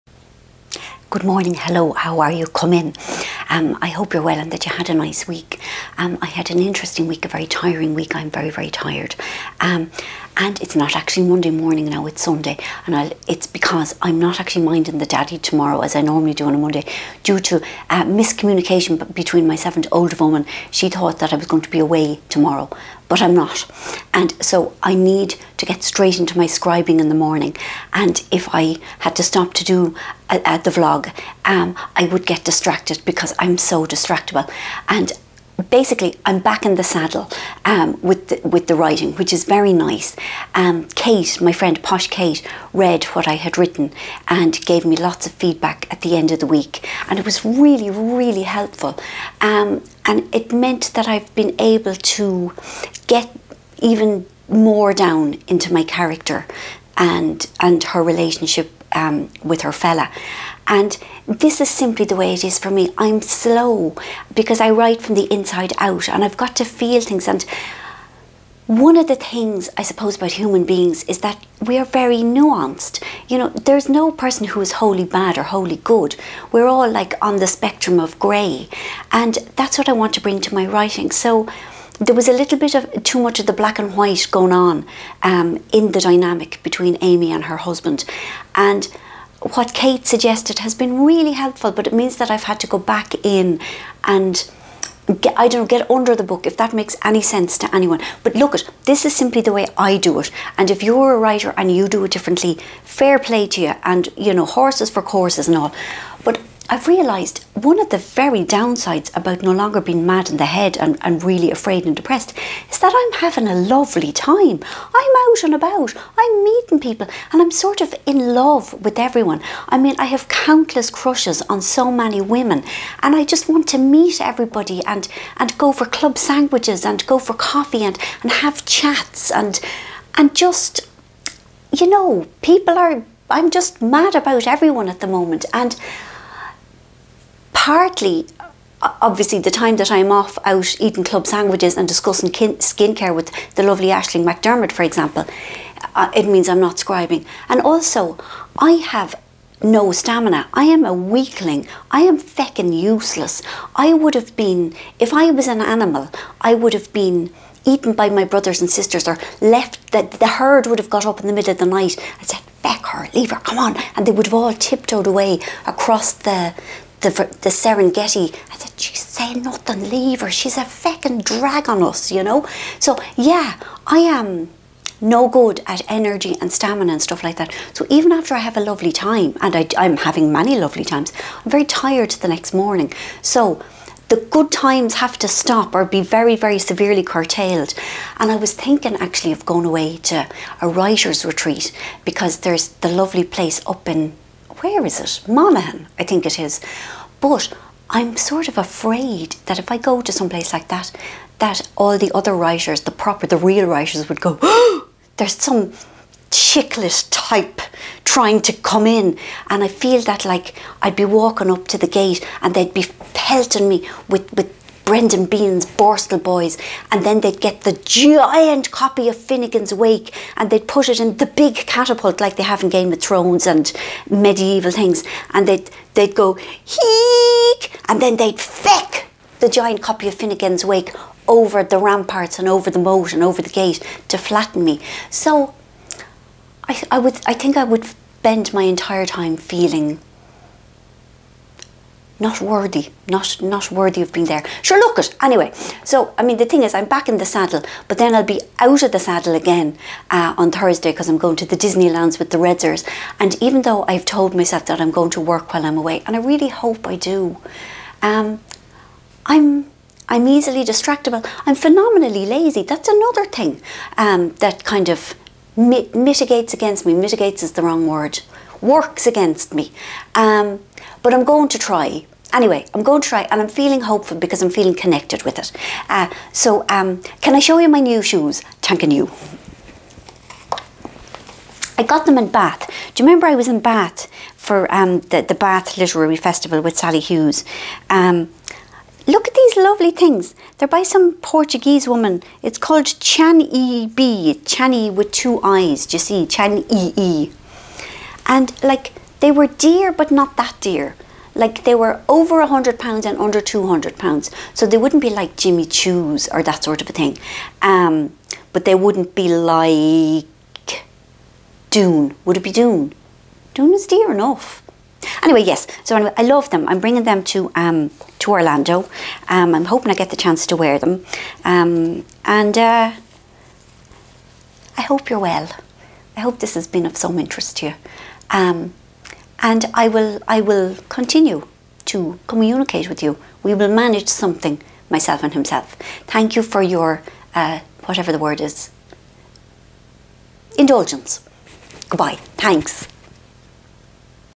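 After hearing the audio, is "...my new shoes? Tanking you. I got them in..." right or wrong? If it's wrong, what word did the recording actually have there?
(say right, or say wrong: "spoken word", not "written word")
right.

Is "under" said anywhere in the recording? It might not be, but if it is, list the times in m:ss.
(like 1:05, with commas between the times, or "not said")
1:35, 5:03.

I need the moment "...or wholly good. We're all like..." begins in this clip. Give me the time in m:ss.
1:15.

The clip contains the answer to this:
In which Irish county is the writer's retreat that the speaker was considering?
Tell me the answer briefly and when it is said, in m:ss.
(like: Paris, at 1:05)
Monaghan, at 3:15.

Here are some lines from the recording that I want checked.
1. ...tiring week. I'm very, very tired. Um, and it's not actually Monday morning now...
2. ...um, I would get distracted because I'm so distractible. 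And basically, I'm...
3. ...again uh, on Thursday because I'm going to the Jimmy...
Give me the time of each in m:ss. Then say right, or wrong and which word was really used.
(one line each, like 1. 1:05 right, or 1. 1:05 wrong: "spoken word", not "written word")
1. 0:07 right
2. 0:31 right
3. 4:09 wrong: "Disneylands", not "Jimmy".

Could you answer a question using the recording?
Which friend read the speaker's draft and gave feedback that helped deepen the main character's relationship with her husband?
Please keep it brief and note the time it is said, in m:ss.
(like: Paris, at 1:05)
Posh Kate, at 0:41.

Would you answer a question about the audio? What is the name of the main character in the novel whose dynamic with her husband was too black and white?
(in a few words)
Amy.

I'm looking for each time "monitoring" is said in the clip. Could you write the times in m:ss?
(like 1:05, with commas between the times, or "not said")
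not said.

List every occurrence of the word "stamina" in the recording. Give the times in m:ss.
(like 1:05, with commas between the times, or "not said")
2:29, 2:56.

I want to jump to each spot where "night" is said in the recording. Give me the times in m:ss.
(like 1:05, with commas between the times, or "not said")
2:41.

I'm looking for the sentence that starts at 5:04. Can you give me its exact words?
So they wouldn't be like Jimmy Choo's or that sort of a thing.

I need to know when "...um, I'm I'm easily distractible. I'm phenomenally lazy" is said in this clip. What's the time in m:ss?
4:18.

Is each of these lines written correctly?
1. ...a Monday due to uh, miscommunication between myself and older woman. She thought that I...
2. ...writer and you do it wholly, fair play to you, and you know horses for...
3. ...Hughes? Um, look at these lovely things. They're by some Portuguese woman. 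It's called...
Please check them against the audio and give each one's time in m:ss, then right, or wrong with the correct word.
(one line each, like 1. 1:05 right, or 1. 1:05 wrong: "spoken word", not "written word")
1. 0:16 right
2. 1:41 wrong: "differently", not "wholly"
3. 4:46 right.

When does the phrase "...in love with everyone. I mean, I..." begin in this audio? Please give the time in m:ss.
1:58.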